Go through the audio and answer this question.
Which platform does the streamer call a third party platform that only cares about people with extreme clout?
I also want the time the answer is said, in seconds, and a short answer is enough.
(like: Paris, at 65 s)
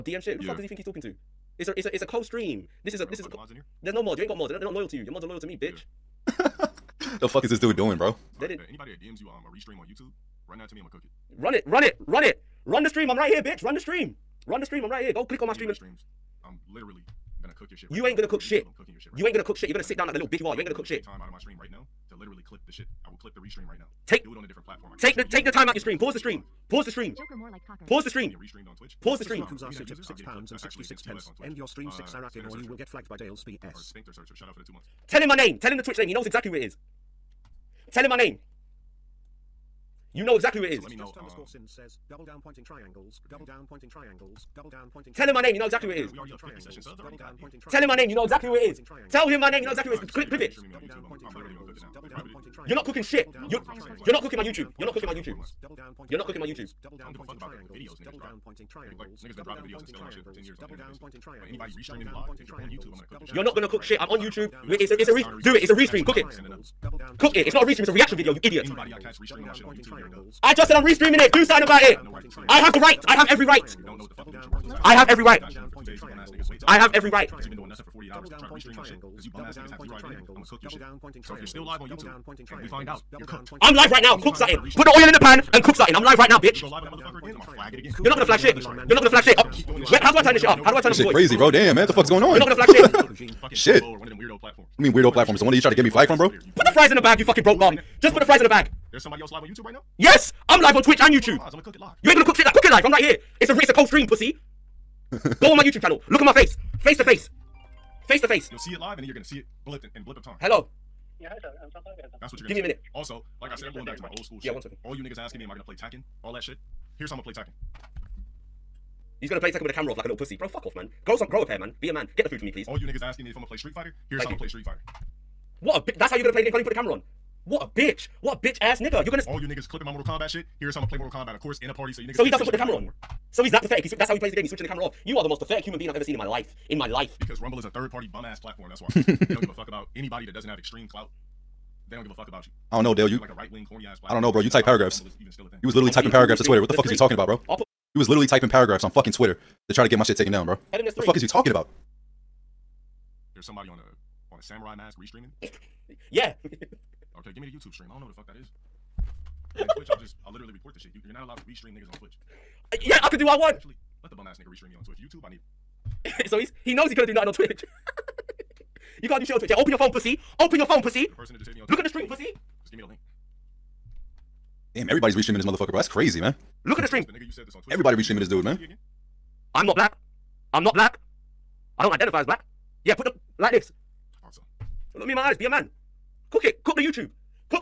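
Rumble, at 137 s.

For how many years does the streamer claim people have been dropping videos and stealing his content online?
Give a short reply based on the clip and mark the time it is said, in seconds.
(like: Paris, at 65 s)
10, at 60 s.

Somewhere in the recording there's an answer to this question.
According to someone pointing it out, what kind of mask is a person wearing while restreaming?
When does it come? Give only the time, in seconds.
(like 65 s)
154 s.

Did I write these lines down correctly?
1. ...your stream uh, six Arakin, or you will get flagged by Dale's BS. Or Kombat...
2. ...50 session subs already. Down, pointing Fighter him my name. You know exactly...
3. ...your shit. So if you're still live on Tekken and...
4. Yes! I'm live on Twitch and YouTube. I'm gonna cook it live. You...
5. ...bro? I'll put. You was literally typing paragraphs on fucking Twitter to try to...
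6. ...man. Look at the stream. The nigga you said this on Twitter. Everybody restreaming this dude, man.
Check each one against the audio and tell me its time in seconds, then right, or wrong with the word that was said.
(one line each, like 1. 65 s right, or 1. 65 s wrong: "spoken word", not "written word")
1. 31 s wrong: "Spinkter", not "Kombat"
2. 46 s wrong: "Tell", not "Fighter"
3. 80 s wrong: "YouTube", not "Tekken"
4. 99 s right
5. 147 s right
6. 176 s right.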